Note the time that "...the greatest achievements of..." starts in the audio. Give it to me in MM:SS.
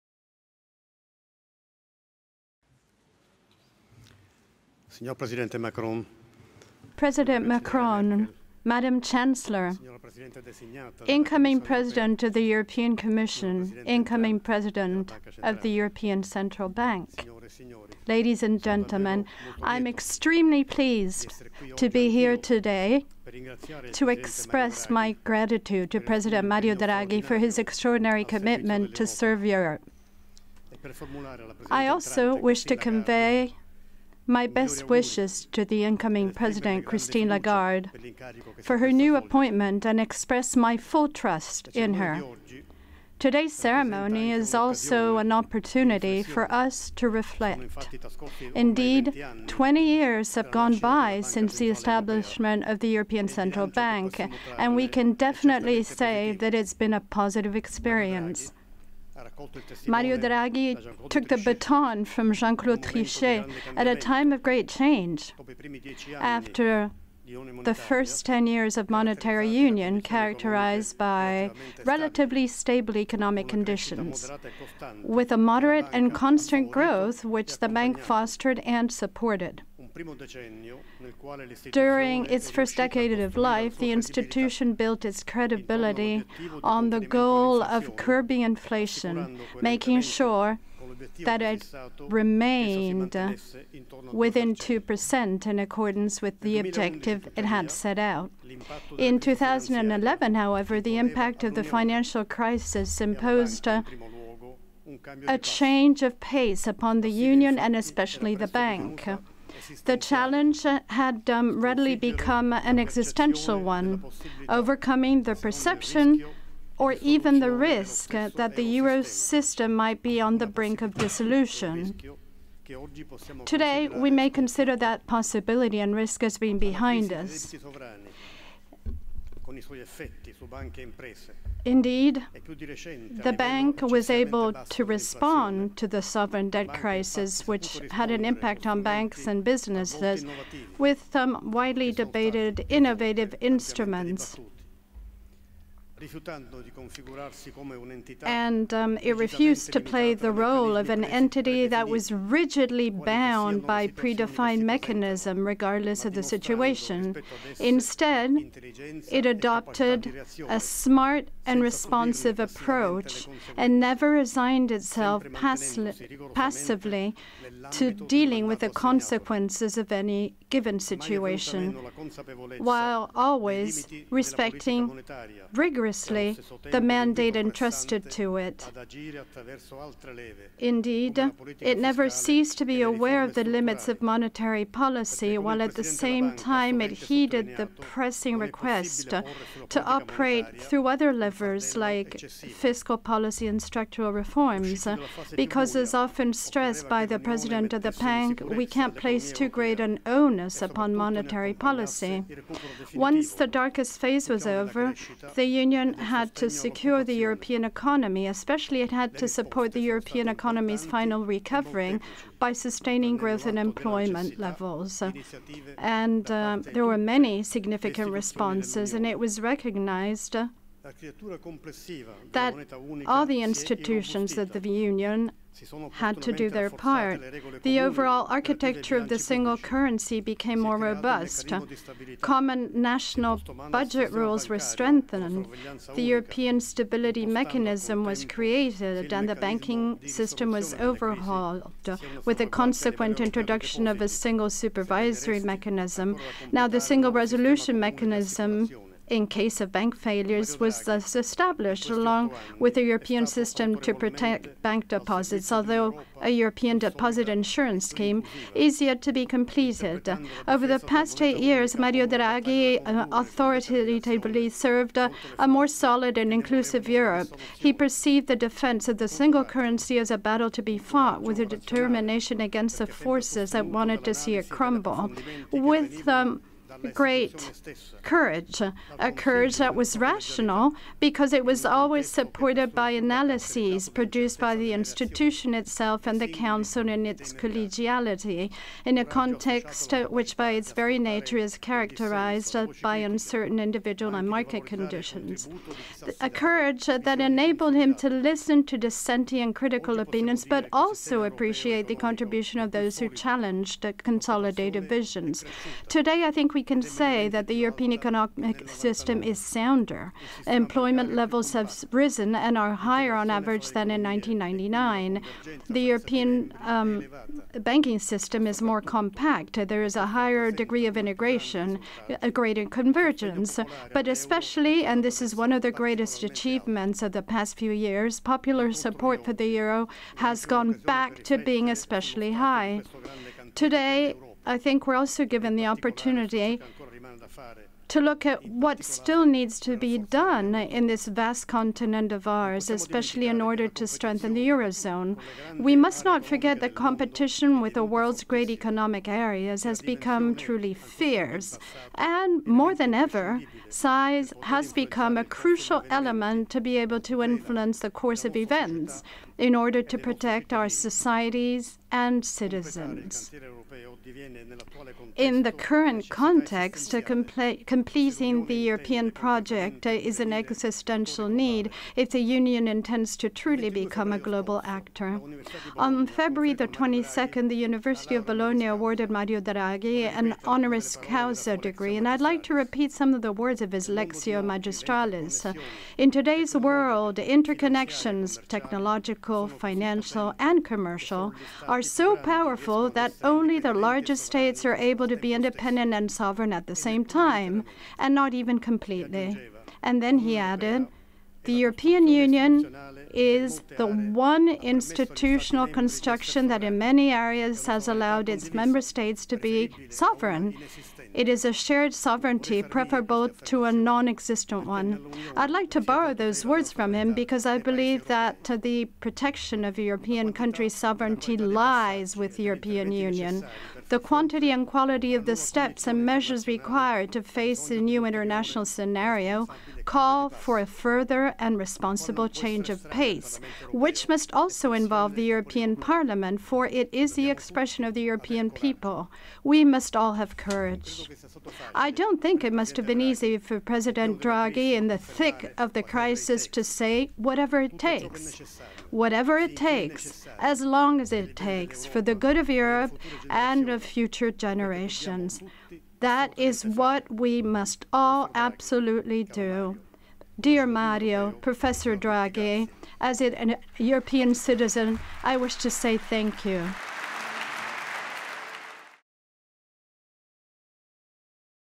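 05:25.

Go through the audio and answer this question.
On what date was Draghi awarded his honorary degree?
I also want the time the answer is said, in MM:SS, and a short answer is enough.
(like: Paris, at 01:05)
February 22, at 06:16.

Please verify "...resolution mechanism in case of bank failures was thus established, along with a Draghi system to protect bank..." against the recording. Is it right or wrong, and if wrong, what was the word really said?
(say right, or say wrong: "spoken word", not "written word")
wrong: "European", not "Draghi".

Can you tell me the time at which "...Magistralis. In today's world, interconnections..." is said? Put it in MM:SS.
06:24.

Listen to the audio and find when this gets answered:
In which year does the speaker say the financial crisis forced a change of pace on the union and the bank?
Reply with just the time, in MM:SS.
01:39.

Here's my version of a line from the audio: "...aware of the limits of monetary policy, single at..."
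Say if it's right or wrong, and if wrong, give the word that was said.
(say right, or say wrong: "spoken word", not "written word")
wrong: "while", not "single".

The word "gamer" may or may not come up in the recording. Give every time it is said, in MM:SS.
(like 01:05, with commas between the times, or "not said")
not said.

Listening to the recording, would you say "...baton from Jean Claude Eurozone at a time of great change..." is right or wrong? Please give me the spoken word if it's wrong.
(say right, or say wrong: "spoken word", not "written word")
wrong: "Trichet", not "Eurozone".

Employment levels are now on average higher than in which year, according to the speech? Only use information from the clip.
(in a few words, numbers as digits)
1999.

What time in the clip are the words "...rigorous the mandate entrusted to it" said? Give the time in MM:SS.
02:55.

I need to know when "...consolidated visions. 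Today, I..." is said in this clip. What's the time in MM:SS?
05:04.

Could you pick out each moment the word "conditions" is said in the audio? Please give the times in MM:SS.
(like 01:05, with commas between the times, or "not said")
01:13, 04:54.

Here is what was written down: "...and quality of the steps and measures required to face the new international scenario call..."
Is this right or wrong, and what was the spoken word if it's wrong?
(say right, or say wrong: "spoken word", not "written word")
right.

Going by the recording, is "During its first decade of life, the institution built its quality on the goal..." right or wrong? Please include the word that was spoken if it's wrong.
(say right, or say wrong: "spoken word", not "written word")
wrong: "credibility", not "quality".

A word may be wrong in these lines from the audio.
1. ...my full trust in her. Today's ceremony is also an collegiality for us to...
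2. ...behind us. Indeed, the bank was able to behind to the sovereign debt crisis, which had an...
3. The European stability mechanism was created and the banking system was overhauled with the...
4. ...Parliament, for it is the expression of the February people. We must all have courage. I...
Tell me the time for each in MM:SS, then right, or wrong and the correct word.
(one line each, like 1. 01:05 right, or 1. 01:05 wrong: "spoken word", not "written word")
1. 00:40 wrong: "opportunity", not "collegiality"
2. 02:06 wrong: "respond", not "behind"
3. 03:55 right
4. 07:15 wrong: "European", not "February".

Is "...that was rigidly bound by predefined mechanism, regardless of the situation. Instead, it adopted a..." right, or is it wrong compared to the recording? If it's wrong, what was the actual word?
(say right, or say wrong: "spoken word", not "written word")
right.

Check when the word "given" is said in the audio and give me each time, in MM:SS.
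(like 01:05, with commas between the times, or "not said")
02:50, 05:35.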